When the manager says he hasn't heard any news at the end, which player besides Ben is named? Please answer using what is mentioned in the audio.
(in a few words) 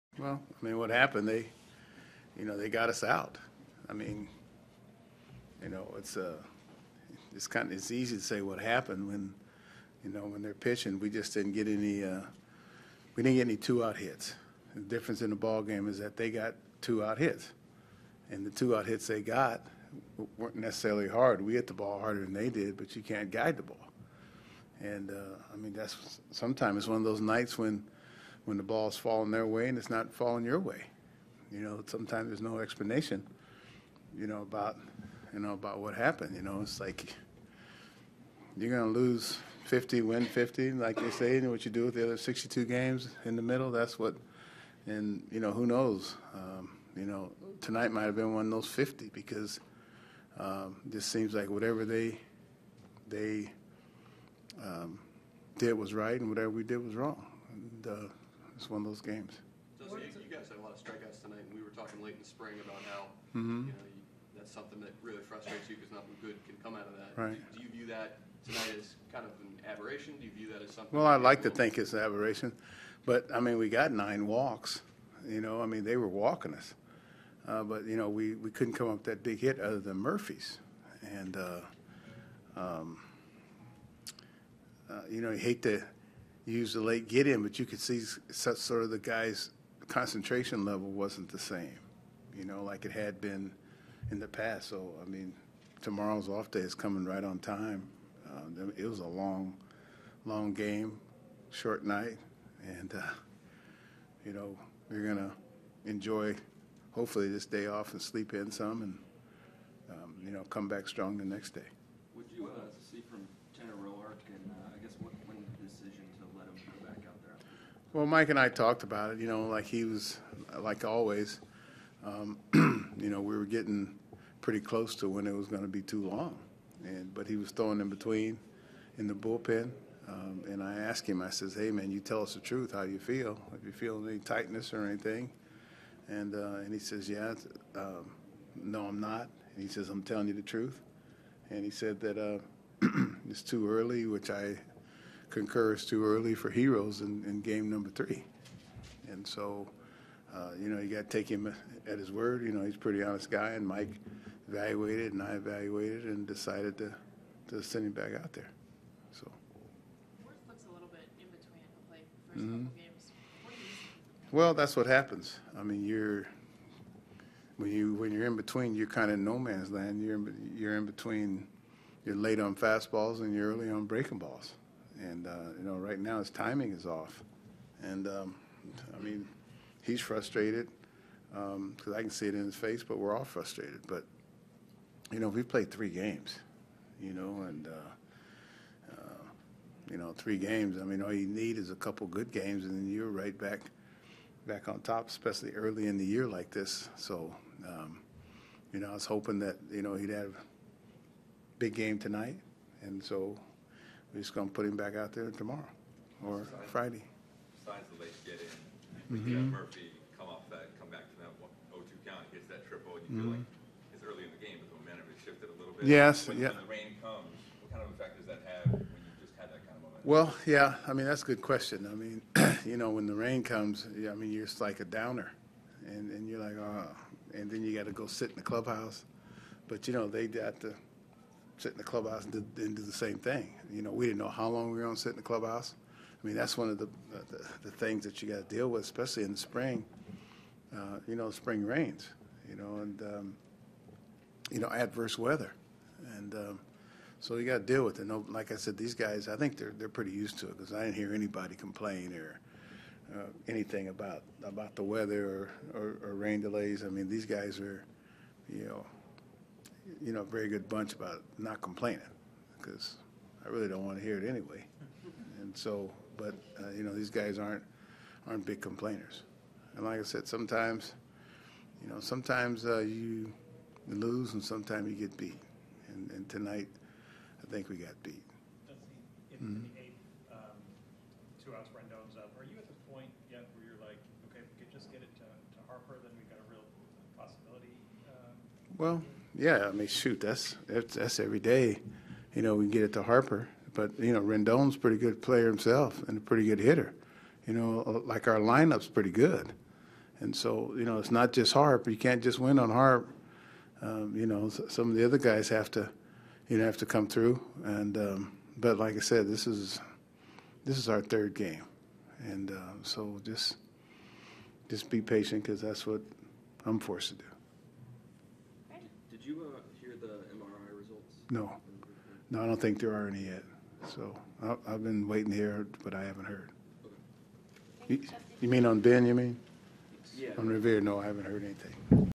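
Revere.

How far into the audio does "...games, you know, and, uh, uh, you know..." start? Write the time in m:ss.
3:05.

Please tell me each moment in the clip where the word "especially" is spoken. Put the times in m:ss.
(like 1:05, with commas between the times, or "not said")
3:15, 3:58.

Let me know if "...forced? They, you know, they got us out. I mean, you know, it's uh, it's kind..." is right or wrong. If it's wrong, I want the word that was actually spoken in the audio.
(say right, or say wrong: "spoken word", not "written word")
wrong: "happened", not "forced".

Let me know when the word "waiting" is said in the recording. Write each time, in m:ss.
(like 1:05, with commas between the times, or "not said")
5:25.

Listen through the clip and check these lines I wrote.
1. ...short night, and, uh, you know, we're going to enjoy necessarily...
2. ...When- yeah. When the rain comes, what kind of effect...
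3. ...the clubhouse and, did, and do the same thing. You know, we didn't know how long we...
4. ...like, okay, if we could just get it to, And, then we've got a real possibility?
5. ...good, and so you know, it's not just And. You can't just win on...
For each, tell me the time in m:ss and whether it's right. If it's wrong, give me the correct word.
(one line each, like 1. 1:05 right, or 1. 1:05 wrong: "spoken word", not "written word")
1. 1:41 wrong: "hopefully", not "necessarily"
2. 3:36 right
3. 3:51 right
4. 4:43 wrong: "Harper", not "And"
5. 4:59 wrong: "Harp", not "And".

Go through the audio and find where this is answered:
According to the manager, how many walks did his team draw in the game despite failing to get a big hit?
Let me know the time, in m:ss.
1:13.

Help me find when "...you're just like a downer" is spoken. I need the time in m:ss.
3:44.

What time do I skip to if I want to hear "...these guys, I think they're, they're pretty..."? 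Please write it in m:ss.
4:08.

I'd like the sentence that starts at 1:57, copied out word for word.
Well, Mike and I talked about it.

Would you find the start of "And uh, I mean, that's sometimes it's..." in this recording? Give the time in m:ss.
0:24.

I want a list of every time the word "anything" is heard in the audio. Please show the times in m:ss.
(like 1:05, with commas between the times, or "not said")
2:14, 4:13, 5:31.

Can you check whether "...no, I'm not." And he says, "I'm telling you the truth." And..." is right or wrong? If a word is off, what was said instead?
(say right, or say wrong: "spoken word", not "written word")
right.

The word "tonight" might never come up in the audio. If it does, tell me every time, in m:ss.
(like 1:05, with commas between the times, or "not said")
0:47, 1:01, 1:08, 3:21, 4:36.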